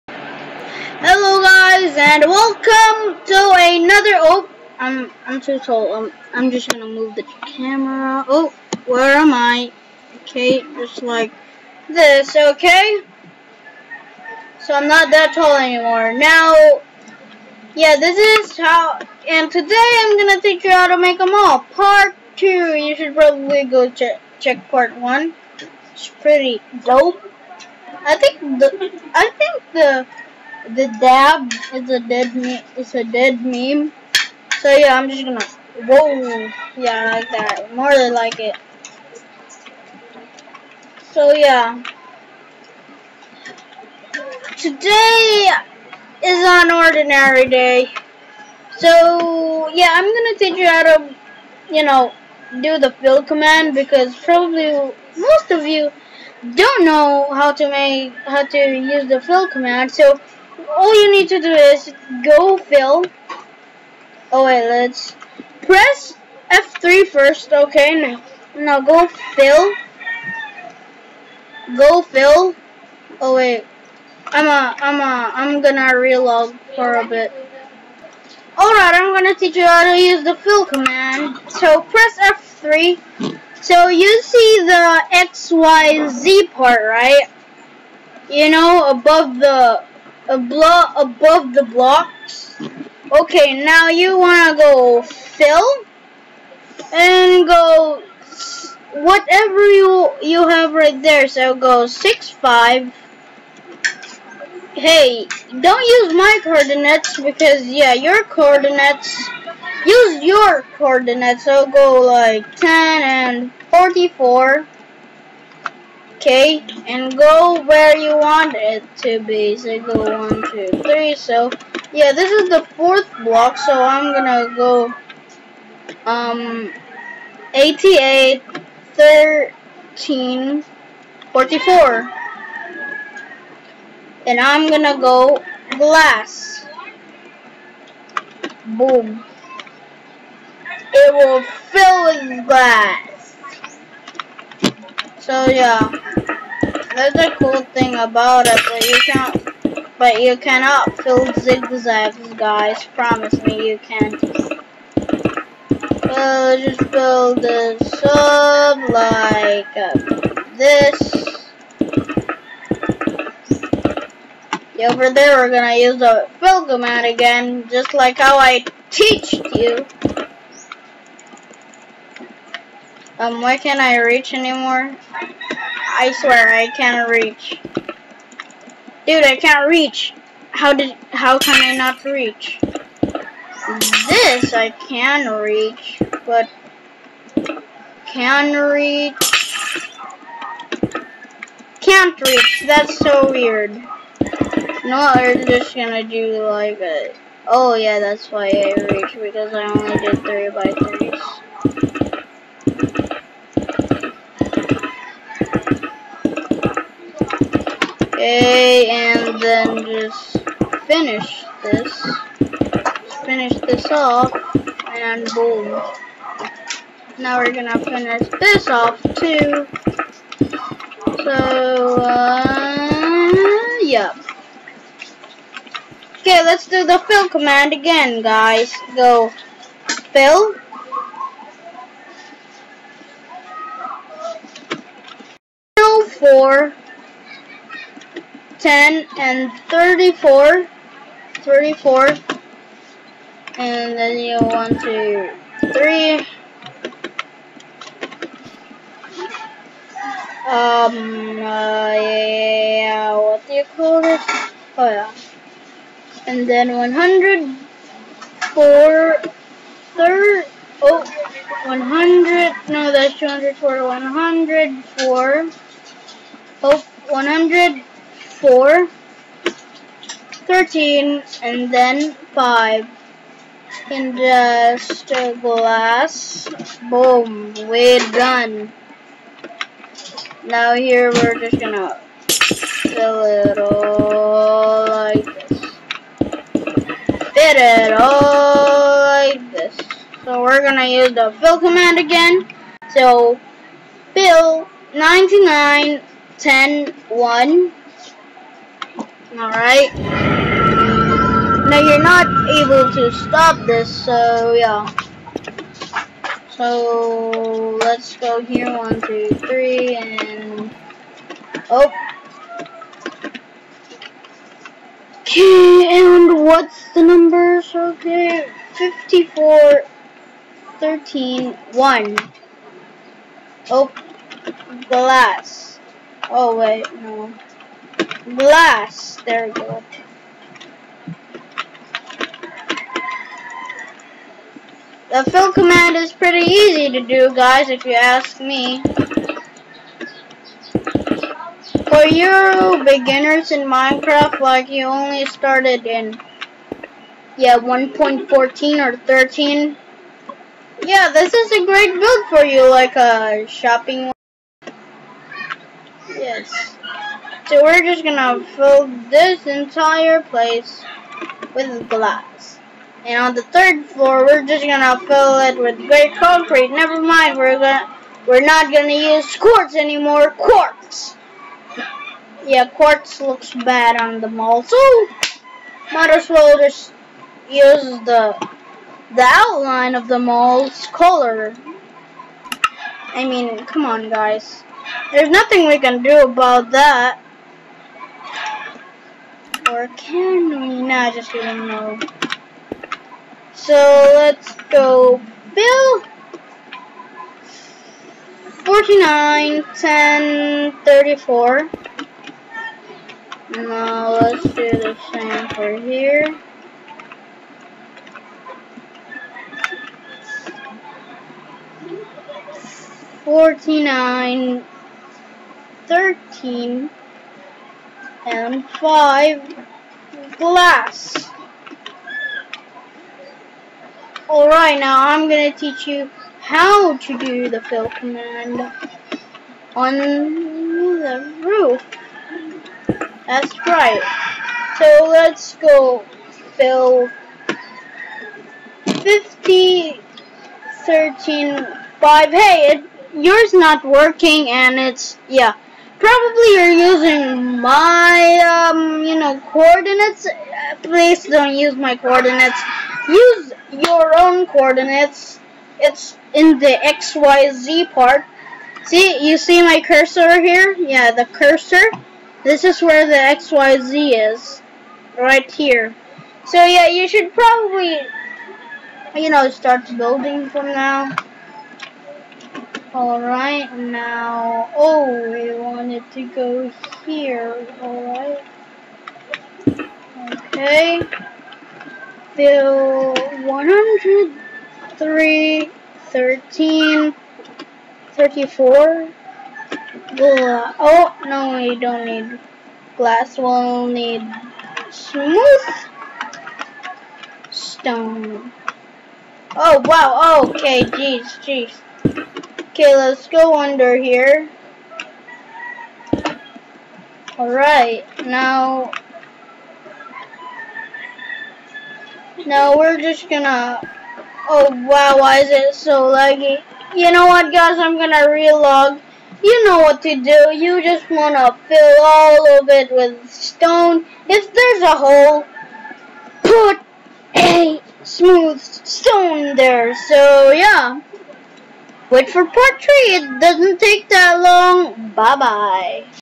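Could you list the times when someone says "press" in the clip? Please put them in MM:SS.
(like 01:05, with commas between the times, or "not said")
01:05, 01:21.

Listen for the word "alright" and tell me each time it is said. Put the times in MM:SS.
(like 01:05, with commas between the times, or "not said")
01:18, 04:59, 07:04, 07:52, 07:57, 08:27.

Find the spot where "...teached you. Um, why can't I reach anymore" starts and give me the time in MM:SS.
02:48.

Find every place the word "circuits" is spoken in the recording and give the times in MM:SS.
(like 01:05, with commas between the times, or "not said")
not said.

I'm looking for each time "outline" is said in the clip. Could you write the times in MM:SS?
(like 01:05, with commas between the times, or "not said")
06:19.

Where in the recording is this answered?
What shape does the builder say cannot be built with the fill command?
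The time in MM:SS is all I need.
02:31.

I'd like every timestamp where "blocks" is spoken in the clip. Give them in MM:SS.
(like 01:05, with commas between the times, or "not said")
01:31, 02:03.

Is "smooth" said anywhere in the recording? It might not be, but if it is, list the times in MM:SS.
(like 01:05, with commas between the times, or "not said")
08:14, 08:48.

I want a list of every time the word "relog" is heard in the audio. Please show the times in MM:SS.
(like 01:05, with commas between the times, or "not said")
01:15, 08:38.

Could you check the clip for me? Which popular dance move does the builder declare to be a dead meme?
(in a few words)
The dab.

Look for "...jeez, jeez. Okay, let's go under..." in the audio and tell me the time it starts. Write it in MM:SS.
08:20.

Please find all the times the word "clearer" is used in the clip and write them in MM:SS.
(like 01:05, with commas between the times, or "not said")
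not said.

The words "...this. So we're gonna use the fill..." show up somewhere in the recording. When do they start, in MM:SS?
04:49.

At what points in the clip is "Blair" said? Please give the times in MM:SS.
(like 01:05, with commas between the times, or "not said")
not said.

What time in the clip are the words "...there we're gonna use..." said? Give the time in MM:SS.
02:45.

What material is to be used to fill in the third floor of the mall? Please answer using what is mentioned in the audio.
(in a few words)
Gray concrete.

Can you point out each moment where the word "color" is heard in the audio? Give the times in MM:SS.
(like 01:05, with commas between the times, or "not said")
06:20.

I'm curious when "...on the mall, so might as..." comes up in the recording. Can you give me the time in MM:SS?
06:14.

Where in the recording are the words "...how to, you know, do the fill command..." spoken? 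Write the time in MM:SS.
00:50.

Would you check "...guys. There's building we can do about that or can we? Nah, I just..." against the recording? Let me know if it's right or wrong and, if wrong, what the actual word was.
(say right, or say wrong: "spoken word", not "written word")
wrong: "nothing", not "building".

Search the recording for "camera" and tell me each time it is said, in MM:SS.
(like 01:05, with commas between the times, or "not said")
00:07.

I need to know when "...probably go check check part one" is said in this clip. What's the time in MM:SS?
00:23.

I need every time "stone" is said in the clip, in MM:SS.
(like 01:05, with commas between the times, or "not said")
08:17, 08:43, 08:48.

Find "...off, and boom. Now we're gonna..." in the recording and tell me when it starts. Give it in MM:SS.
03:33.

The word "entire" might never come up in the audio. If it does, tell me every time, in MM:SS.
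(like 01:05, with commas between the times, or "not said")
05:59.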